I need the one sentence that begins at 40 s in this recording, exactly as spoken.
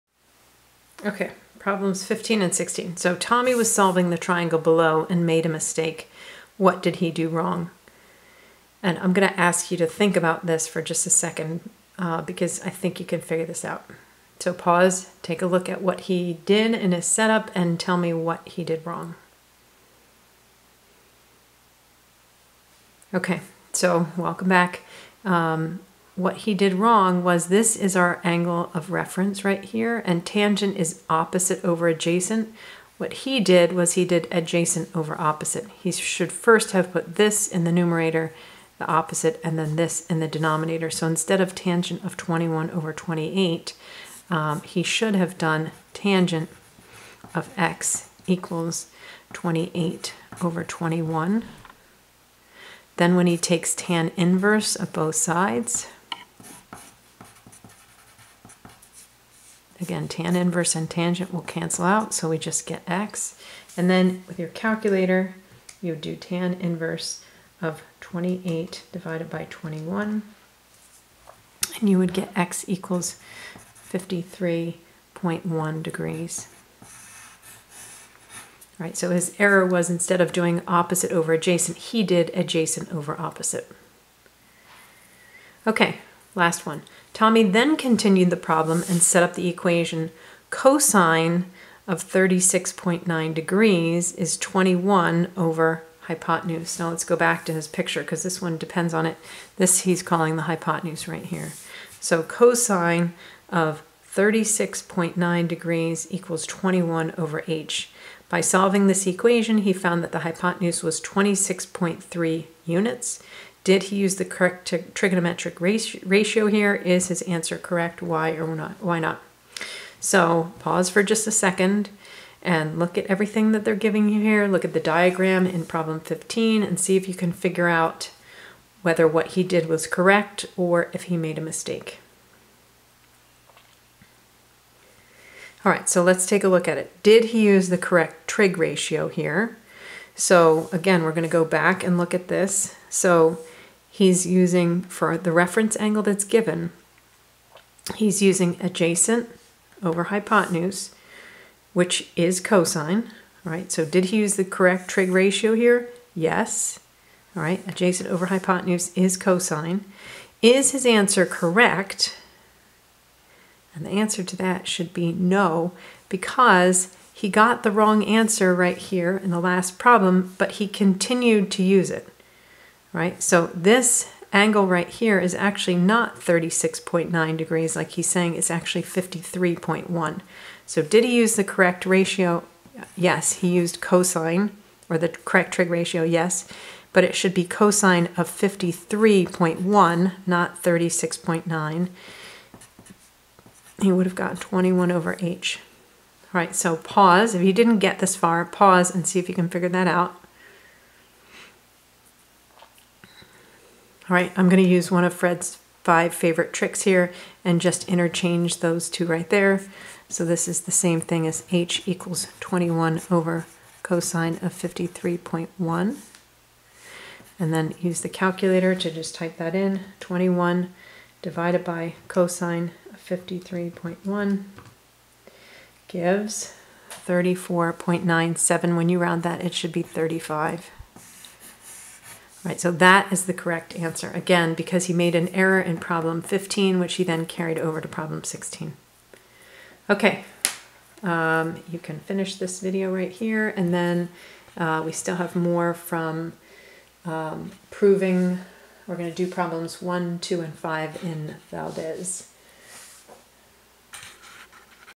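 So instead of tangent of 21 over 28, um, he should have done tangent of x equals 28 over 21.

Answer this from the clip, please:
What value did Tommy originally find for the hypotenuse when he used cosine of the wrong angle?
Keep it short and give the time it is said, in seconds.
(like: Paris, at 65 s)
26.3 units, at 111 s.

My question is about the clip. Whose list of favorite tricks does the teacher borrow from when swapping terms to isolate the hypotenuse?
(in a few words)
Fred's.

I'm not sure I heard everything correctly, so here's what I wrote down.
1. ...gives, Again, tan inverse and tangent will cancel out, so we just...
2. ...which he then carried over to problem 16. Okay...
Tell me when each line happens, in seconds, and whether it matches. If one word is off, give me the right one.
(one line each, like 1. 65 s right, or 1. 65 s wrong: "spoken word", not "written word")
1. 55 s wrong: "sides", not "gives"
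2. 236 s right.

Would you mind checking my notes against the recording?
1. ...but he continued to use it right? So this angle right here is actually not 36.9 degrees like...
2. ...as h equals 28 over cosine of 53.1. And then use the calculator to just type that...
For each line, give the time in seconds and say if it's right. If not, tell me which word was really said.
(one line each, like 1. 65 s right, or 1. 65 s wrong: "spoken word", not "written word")
1. 170 s right
2. 211 s wrong: "21", not "28".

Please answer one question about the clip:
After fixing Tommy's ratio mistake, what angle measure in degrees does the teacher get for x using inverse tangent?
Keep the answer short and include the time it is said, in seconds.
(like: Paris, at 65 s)
53.1 degrees, at 73 s.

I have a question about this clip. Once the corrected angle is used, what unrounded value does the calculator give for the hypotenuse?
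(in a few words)
34.97.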